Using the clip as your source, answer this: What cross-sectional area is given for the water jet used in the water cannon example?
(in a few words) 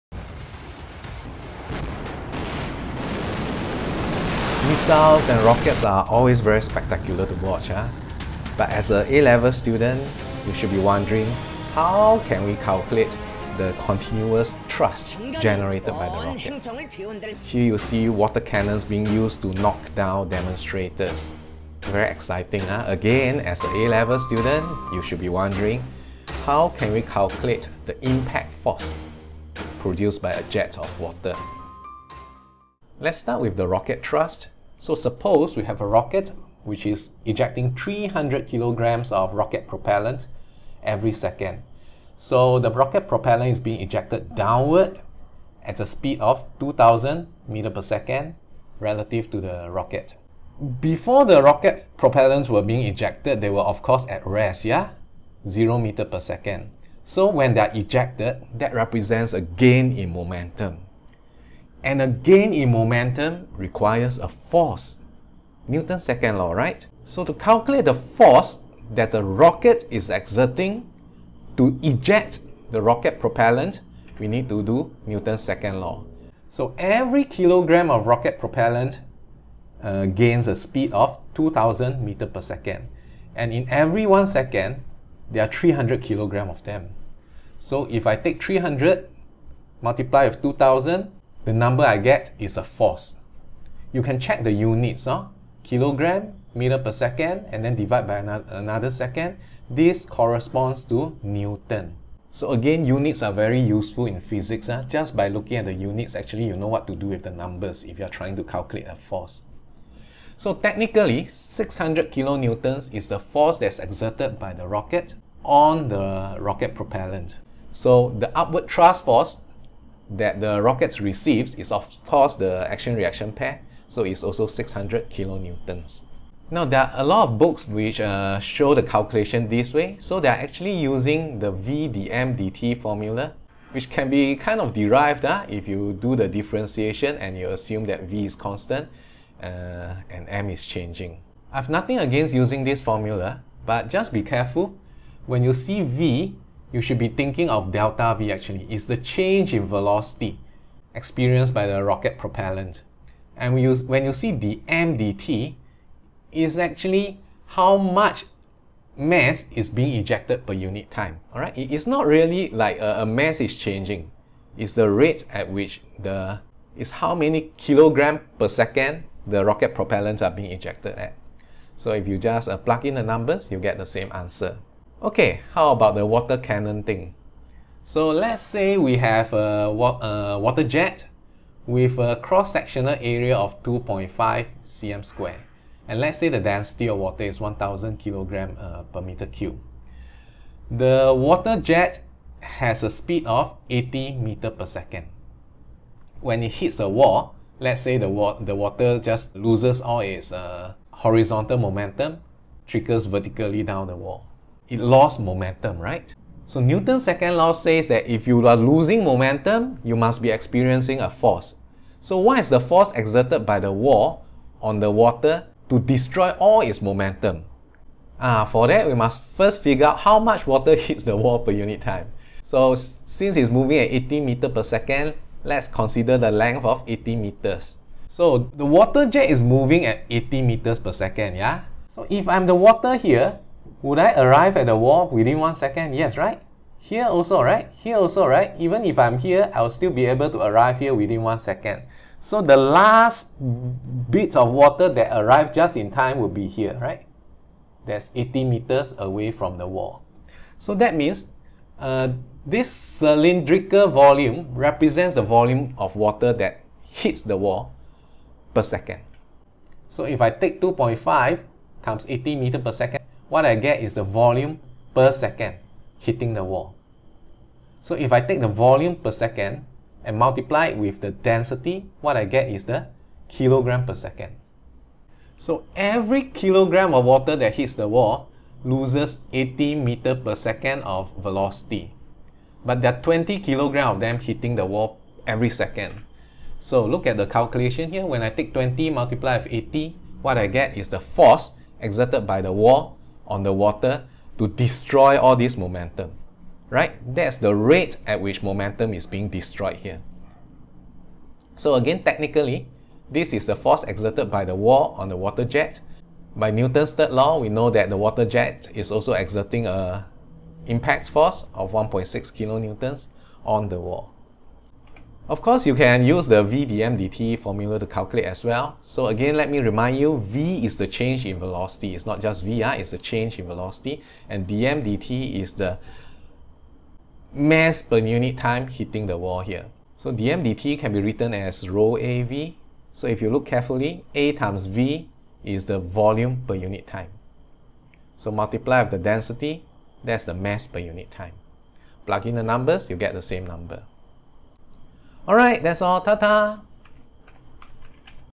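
2.5 cm².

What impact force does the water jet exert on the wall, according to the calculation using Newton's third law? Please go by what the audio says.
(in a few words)
1.6 kilonewtons.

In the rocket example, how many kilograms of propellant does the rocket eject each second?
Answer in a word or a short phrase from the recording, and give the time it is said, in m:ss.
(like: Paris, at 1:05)
300 kilograms, at 0:37.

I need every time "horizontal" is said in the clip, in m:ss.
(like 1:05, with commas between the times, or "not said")
3:20.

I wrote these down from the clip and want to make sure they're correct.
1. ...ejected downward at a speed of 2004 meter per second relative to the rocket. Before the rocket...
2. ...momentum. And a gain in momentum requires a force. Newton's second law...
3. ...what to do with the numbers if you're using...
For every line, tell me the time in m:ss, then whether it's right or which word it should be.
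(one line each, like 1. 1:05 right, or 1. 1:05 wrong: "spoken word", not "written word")
1. 0:43 wrong: "2000", not "2004"
2. 1:00 right
3. 1:46 wrong: "trying", not "using".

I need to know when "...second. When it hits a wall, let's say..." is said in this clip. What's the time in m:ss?
3:14.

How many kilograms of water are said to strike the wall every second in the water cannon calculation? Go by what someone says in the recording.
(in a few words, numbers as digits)
20 kilograms.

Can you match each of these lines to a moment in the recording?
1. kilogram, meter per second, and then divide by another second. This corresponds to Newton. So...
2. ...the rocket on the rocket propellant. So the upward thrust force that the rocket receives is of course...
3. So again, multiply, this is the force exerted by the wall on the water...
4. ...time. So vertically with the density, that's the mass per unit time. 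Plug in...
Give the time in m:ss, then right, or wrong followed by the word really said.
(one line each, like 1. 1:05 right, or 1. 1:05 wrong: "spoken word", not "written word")
1. 1:35 right
2. 1:54 right
3. 5:01 wrong: "technically", not "multiply"
4. 5:36 wrong: "multiply", not "vertically".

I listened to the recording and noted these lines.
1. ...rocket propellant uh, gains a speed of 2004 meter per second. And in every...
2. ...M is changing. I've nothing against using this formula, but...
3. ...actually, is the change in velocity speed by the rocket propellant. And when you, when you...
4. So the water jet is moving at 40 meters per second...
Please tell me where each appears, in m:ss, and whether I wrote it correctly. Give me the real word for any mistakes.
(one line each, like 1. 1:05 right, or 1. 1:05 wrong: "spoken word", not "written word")
1. 1:18 wrong: "2000", not "2004"
2. 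2:20 right
3. 2:28 wrong: "experienced", not "speed"
4. 3:48 wrong: "80", not "40".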